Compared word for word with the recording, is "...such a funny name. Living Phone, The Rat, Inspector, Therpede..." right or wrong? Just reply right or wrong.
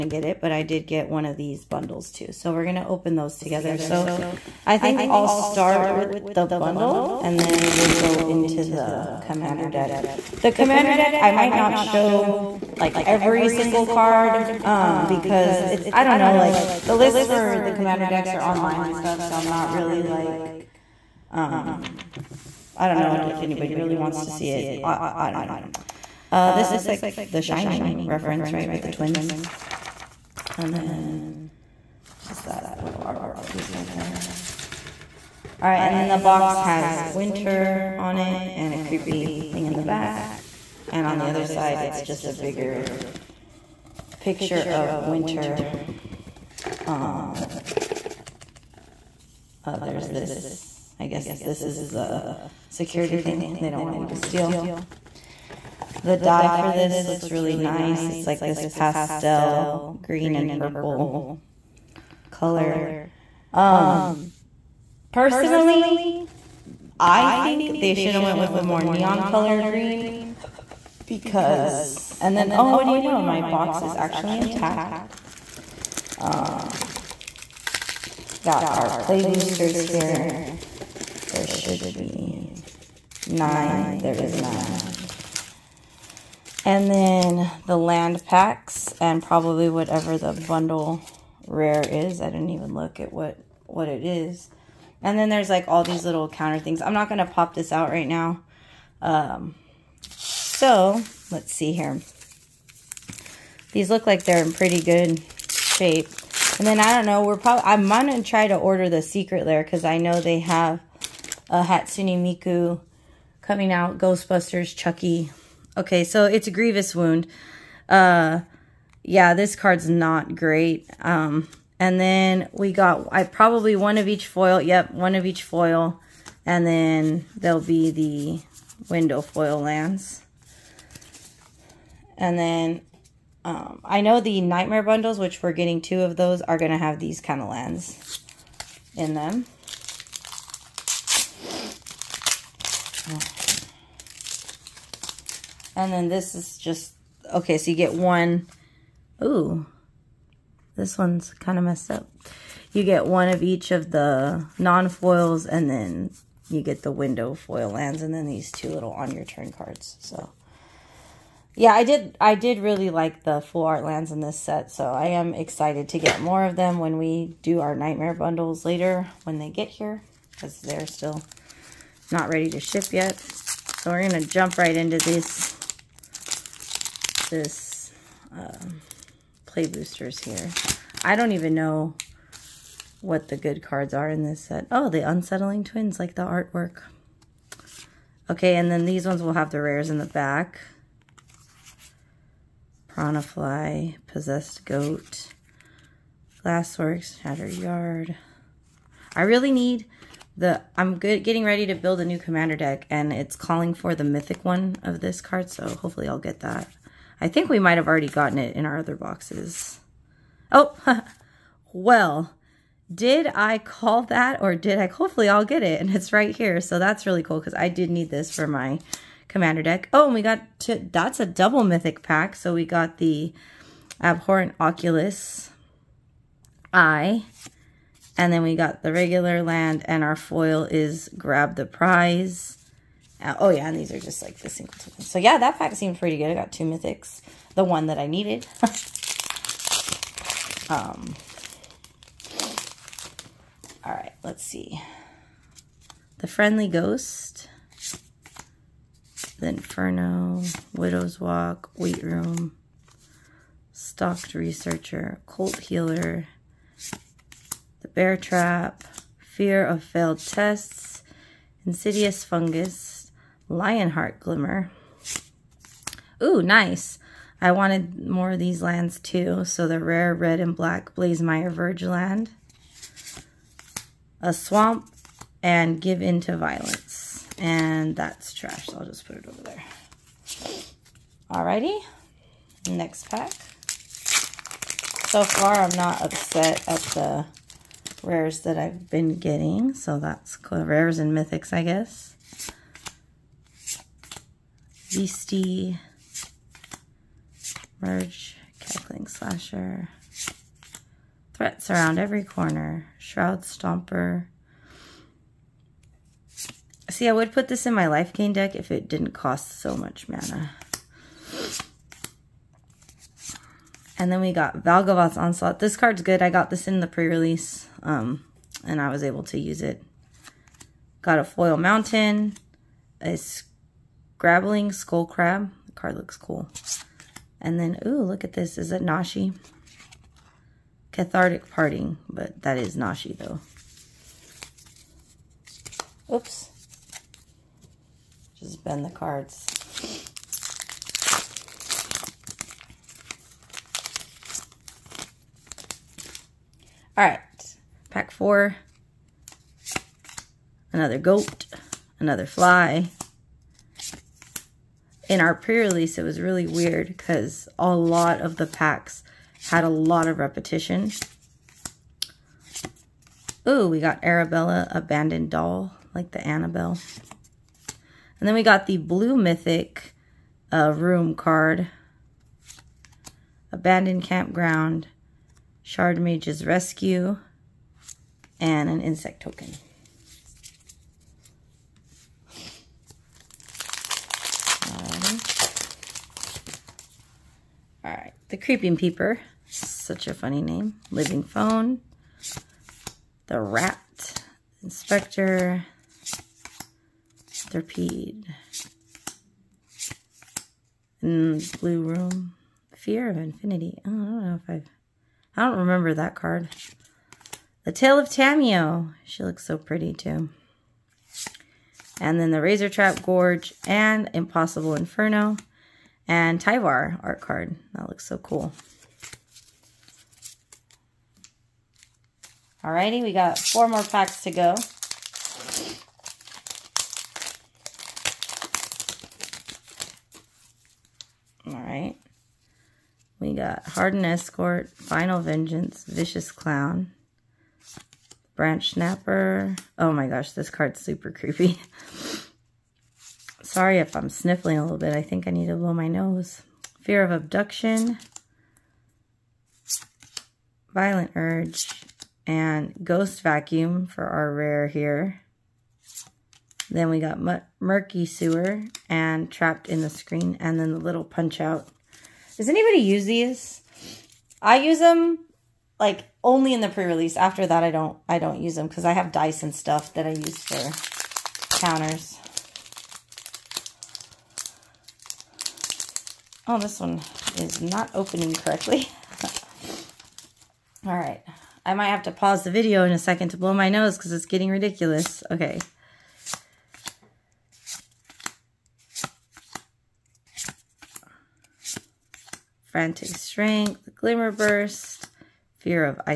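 right.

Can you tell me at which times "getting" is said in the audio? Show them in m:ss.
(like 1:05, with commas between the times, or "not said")
2:15, 3:21, 4:49, 8:04.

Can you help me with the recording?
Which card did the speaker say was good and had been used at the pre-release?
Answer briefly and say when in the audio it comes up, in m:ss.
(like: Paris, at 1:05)
Valgavoth's Onslaught, at 5:14.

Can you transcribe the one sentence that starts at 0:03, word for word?
So I think I'll start with the bundle and then we'll go into the commander deck.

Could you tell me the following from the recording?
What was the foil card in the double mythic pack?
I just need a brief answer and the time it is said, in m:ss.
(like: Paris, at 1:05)
Grab the Prize, at 3:51.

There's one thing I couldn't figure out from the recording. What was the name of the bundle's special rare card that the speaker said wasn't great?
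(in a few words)
Grievous Wound.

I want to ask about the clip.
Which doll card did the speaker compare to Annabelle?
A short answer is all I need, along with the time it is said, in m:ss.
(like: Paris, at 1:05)
Arabella, Abandoned Doll, at 6:04.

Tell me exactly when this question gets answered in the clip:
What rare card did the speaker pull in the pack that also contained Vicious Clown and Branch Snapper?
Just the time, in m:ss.
7:32.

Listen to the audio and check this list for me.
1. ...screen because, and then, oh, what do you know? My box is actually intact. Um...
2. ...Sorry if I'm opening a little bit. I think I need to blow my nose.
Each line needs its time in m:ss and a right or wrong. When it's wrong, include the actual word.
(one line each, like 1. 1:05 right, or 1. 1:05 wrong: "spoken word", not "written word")
1. 1:09 wrong: "green", not "screen"
2. 7:23 wrong: "sniffling", not "opening".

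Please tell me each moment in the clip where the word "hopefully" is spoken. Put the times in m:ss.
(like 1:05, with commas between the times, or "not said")
3:25, 3:34.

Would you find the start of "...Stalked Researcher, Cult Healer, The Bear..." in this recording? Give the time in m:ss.
4:13.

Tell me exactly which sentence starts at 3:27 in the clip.
I think we might have already gotten it in our other boxes.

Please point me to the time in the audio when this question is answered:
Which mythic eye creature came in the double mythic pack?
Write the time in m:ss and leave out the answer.
3:44.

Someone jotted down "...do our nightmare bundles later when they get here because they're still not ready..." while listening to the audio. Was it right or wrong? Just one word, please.
right.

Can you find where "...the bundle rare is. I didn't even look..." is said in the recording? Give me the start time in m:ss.
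1:30.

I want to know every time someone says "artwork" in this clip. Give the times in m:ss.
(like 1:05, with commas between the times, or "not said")
0:32, 3:06.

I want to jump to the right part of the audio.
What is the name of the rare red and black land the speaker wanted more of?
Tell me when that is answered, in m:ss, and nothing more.
4:30.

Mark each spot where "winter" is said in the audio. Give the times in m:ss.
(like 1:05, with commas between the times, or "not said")
0:37, 0:44.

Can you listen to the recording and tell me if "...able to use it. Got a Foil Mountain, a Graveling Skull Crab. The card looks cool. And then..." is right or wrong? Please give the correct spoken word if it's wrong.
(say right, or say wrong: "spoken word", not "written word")
right.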